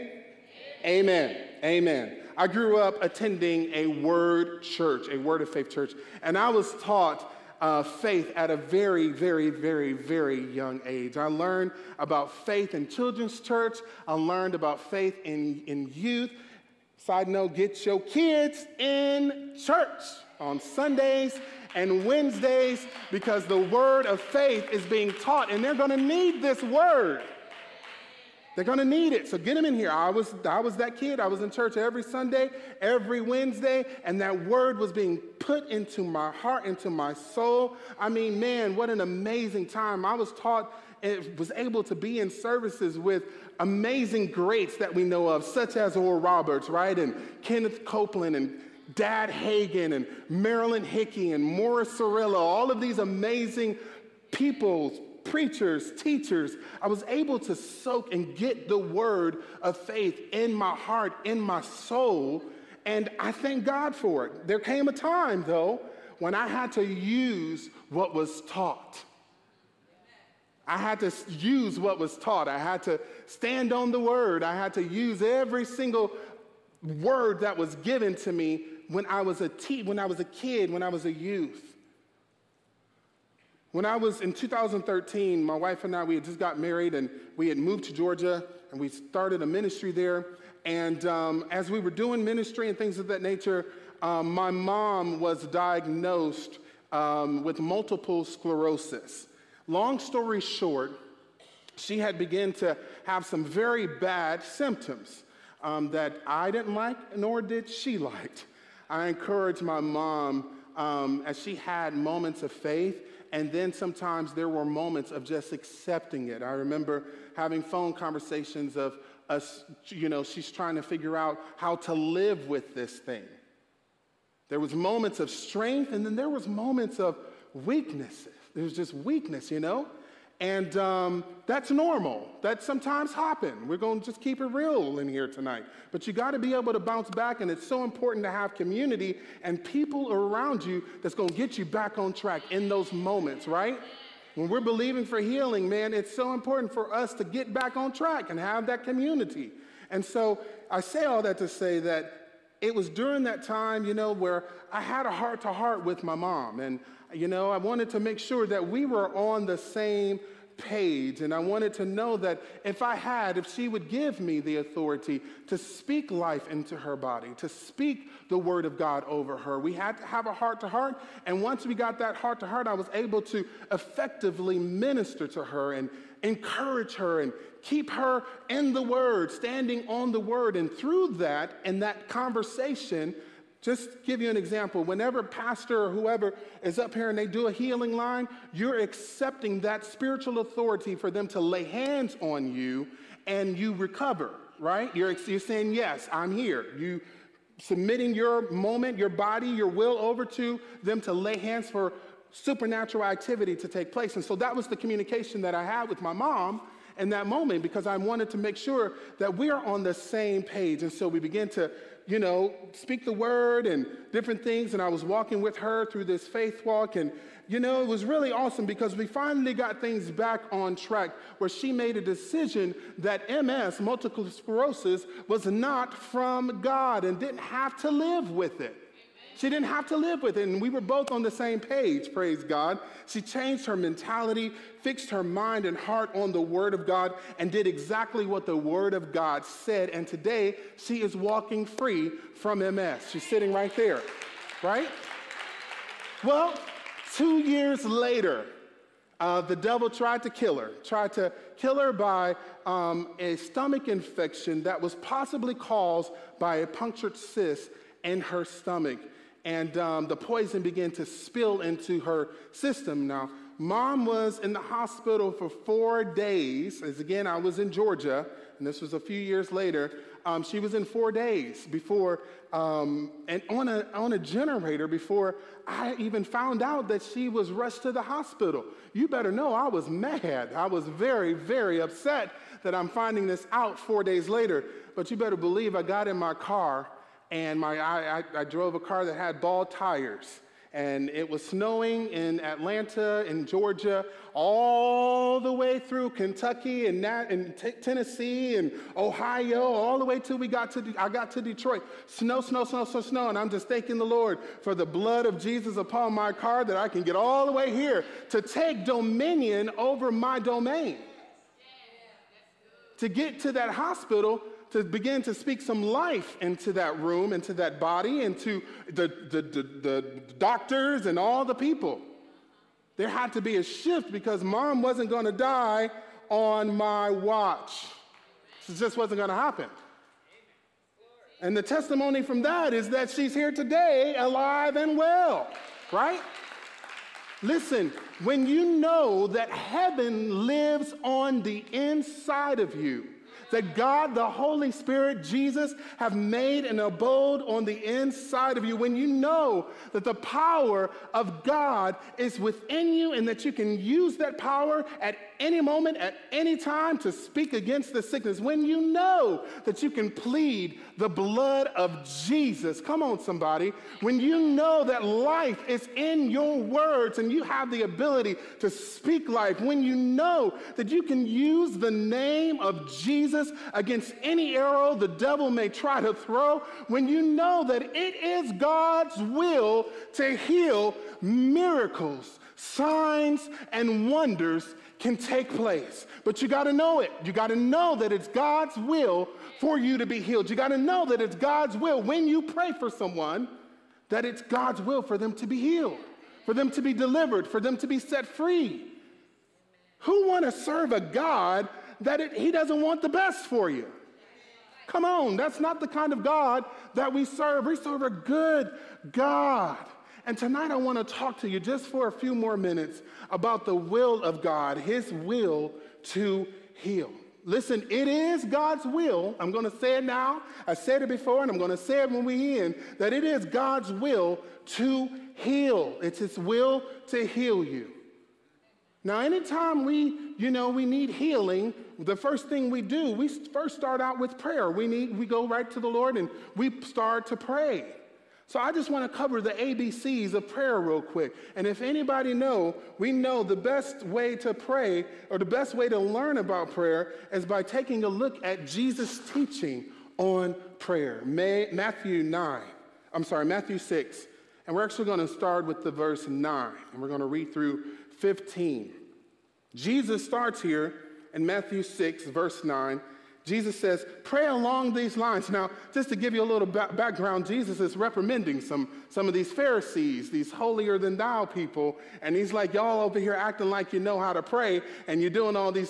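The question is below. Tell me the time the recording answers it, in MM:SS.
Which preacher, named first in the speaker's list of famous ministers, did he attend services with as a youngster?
00:45.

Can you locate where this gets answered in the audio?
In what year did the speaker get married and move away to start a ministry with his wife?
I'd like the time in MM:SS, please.
01:24.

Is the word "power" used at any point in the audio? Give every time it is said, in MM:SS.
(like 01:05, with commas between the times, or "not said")
05:50, 05:54.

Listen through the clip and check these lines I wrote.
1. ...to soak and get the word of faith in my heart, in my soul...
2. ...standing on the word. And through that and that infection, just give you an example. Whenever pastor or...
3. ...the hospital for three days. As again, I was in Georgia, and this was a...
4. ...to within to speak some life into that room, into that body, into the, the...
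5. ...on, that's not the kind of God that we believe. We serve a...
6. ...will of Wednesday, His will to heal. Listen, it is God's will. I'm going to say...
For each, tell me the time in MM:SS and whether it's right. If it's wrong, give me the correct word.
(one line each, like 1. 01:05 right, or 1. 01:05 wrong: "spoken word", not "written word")
1. 00:57 right
2. 02:59 wrong: "conversation", not "infection"
3. 04:24 wrong: "four", not "three"
4. 05:14 wrong: "begin", not "within"
5. 06:45 wrong: "serve", not "believe"
6. 06:53 wrong: "God", not "Wednesday".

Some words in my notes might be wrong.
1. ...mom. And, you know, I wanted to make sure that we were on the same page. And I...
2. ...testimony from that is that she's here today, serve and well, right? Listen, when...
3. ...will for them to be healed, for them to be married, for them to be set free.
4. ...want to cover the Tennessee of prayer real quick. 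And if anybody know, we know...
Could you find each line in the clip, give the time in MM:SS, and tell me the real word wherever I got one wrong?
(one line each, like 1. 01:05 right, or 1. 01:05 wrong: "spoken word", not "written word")
1. 02:36 right
2. 05:31 wrong: "alive", not "serve"
3. 06:34 wrong: "delivered", not "married"
4. 07:18 wrong: "ABCs", not "Tennessee".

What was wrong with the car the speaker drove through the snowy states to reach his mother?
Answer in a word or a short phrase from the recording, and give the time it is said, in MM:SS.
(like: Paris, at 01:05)
Bald tires, at 04:49.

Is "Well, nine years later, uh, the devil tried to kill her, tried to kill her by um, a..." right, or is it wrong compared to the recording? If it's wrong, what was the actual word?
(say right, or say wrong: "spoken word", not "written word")
wrong: "two", not "nine".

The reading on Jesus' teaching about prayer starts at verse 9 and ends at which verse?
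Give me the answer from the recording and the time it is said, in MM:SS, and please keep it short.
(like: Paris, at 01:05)
15, at 07:38.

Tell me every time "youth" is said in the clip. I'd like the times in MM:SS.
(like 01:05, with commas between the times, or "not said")
00:15, 01:21.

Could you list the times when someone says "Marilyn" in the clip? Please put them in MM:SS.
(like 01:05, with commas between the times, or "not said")
00:50.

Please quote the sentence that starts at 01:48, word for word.
I encouraged my mom um, as she had moments of faith, and then sometimes there were moments of just accepting it.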